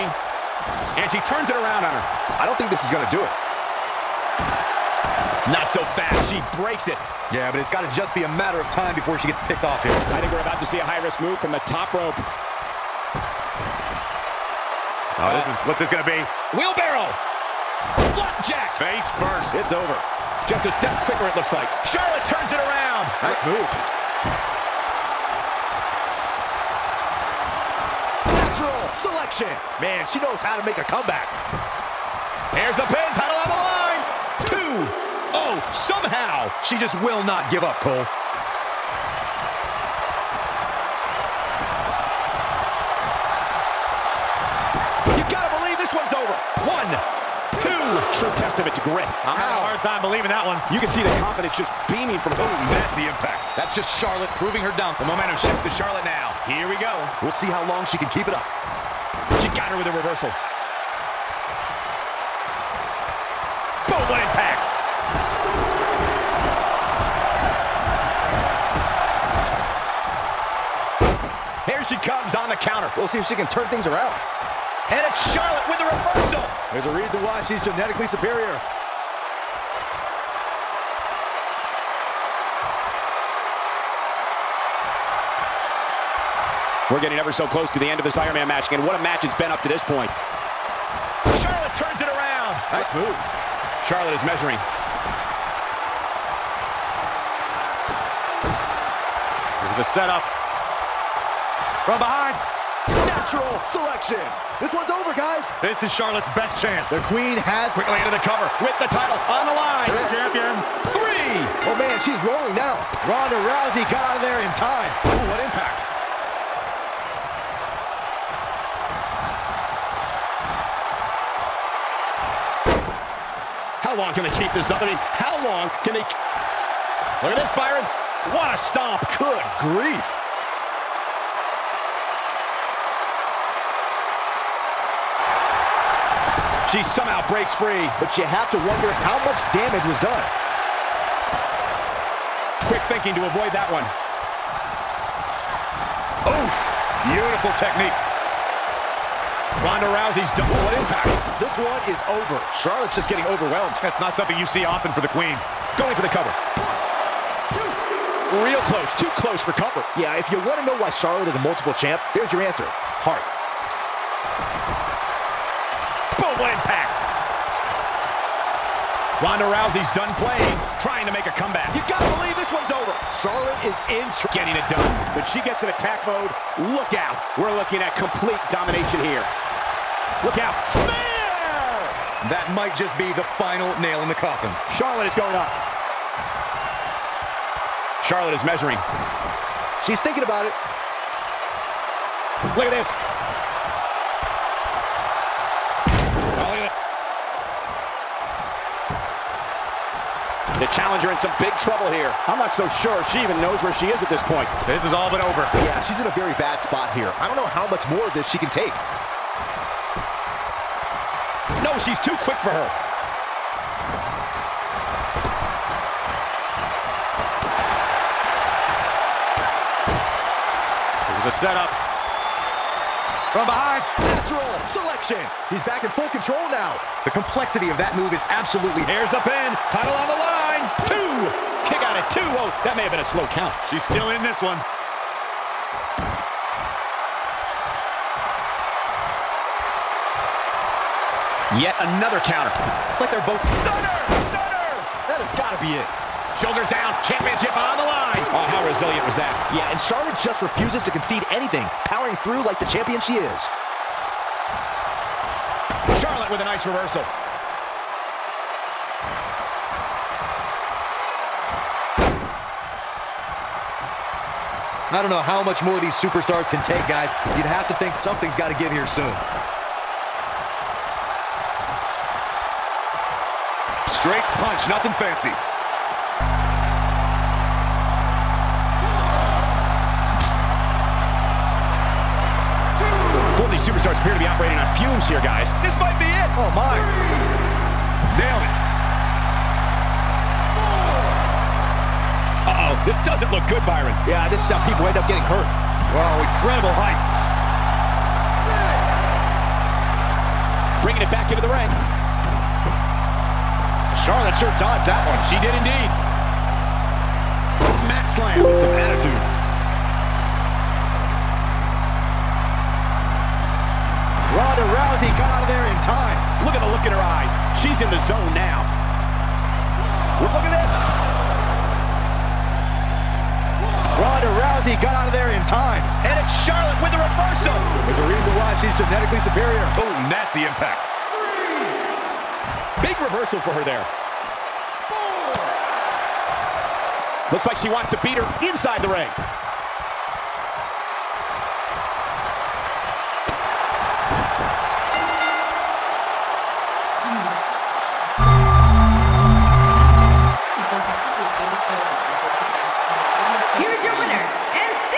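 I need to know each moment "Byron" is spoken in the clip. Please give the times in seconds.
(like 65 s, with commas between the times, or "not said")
127 s, 293 s.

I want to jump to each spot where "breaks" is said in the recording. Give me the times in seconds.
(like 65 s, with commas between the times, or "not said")
6 s, 137 s.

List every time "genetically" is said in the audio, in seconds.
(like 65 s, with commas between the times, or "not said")
77 s, 328 s.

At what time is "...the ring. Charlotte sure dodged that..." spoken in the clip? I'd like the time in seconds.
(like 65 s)
301 s.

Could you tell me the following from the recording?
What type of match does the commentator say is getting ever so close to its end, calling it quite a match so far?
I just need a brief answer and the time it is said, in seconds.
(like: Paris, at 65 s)
Iron Man match, at 88 s.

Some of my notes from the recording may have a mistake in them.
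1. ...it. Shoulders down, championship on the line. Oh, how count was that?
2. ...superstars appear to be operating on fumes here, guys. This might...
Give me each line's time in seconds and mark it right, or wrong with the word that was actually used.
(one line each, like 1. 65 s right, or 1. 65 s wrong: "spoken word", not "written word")
1. 245 s wrong: "resilient", not "count"
2. 283 s right.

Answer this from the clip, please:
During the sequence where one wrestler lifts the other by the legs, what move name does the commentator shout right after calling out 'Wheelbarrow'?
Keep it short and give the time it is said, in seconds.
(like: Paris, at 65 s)
Flapjack, at 18 s.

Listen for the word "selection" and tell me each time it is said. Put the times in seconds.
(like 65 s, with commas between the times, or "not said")
28 s, 103 s, 224 s.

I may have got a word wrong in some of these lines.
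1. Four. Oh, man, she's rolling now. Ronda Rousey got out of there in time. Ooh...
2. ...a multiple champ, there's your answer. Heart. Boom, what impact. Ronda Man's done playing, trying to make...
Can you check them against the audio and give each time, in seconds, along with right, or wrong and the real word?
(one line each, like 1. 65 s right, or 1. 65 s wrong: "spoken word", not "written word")
1. 110 s wrong: "Three", not "Four"
2. 161 s wrong: "Rousey", not "Man".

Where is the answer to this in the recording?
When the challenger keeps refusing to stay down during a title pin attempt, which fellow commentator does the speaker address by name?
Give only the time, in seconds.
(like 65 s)
37 s.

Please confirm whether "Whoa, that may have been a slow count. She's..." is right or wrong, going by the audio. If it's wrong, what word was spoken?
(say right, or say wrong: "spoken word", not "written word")
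right.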